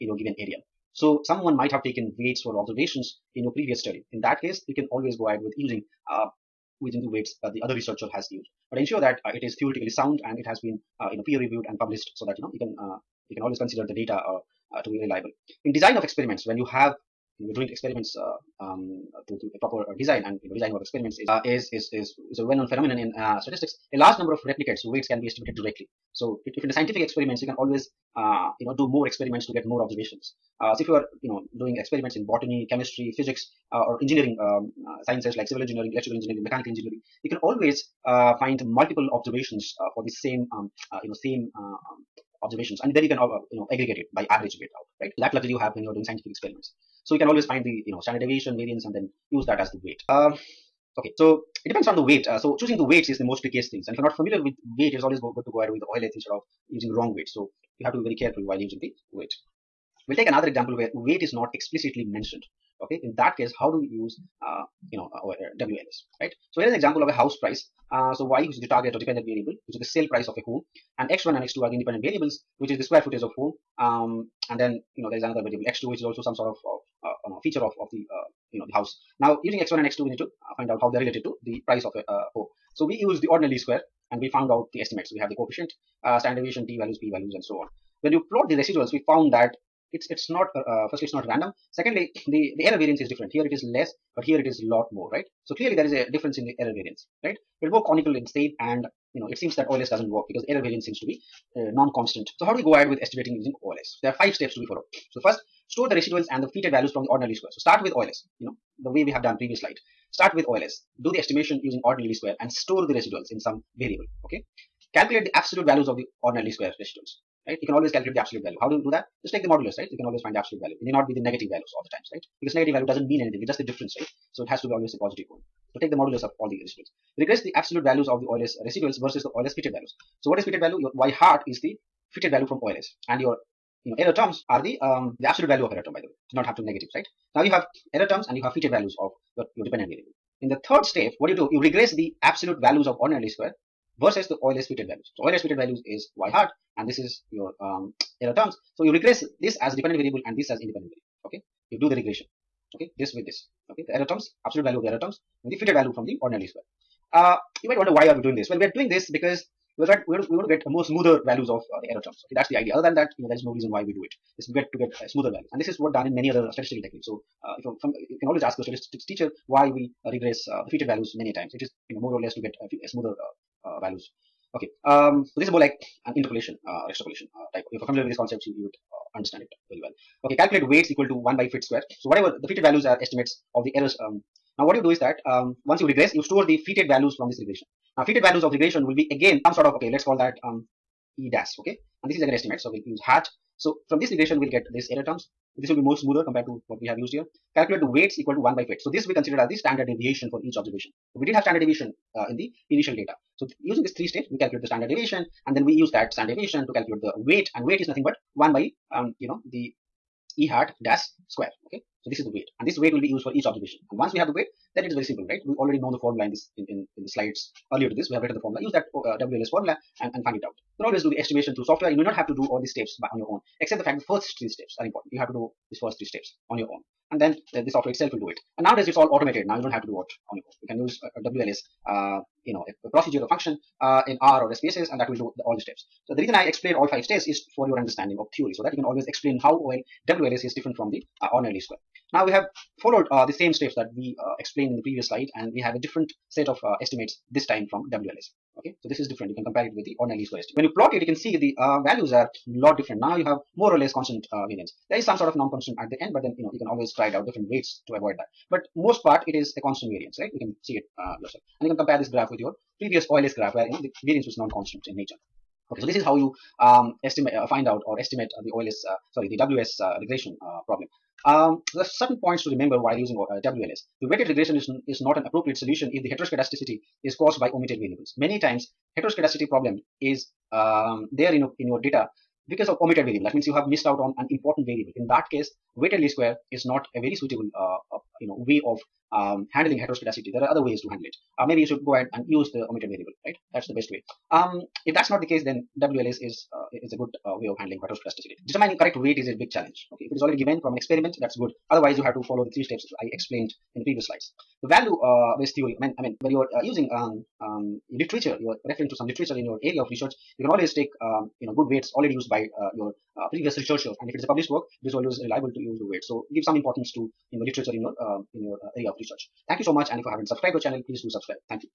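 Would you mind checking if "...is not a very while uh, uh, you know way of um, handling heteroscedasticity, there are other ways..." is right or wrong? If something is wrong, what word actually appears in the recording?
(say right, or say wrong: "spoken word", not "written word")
wrong: "suitable", not "while".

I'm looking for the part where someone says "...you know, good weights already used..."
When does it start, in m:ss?
5:11.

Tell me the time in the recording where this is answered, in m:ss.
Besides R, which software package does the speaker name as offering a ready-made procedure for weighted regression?
3:54.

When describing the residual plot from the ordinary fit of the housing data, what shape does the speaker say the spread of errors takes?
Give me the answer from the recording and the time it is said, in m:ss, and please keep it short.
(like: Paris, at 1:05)
conical, at 1:37.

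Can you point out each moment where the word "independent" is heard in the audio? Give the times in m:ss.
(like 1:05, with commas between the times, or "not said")
1:11, 2:30.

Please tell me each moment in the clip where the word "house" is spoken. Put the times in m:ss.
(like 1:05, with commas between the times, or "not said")
1:07, 1:18.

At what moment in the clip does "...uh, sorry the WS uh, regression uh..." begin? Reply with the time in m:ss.
4:28.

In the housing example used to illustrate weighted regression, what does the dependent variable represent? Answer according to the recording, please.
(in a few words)
sale price of a home.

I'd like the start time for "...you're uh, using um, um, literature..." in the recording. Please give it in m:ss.
5:06.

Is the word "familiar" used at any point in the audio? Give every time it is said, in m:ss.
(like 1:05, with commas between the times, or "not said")
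0:54, 2:57.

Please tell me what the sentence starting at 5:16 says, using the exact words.
So give some importance to, you know, literature in your, um, in your uh, area of research.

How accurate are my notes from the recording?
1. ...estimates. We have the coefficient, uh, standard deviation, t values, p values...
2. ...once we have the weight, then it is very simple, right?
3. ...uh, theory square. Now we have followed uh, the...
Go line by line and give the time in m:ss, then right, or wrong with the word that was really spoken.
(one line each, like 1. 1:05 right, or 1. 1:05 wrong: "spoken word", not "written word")
1. 1:24 right
2. 3:33 right
3. 4:01 wrong: "ordinary", not "theory".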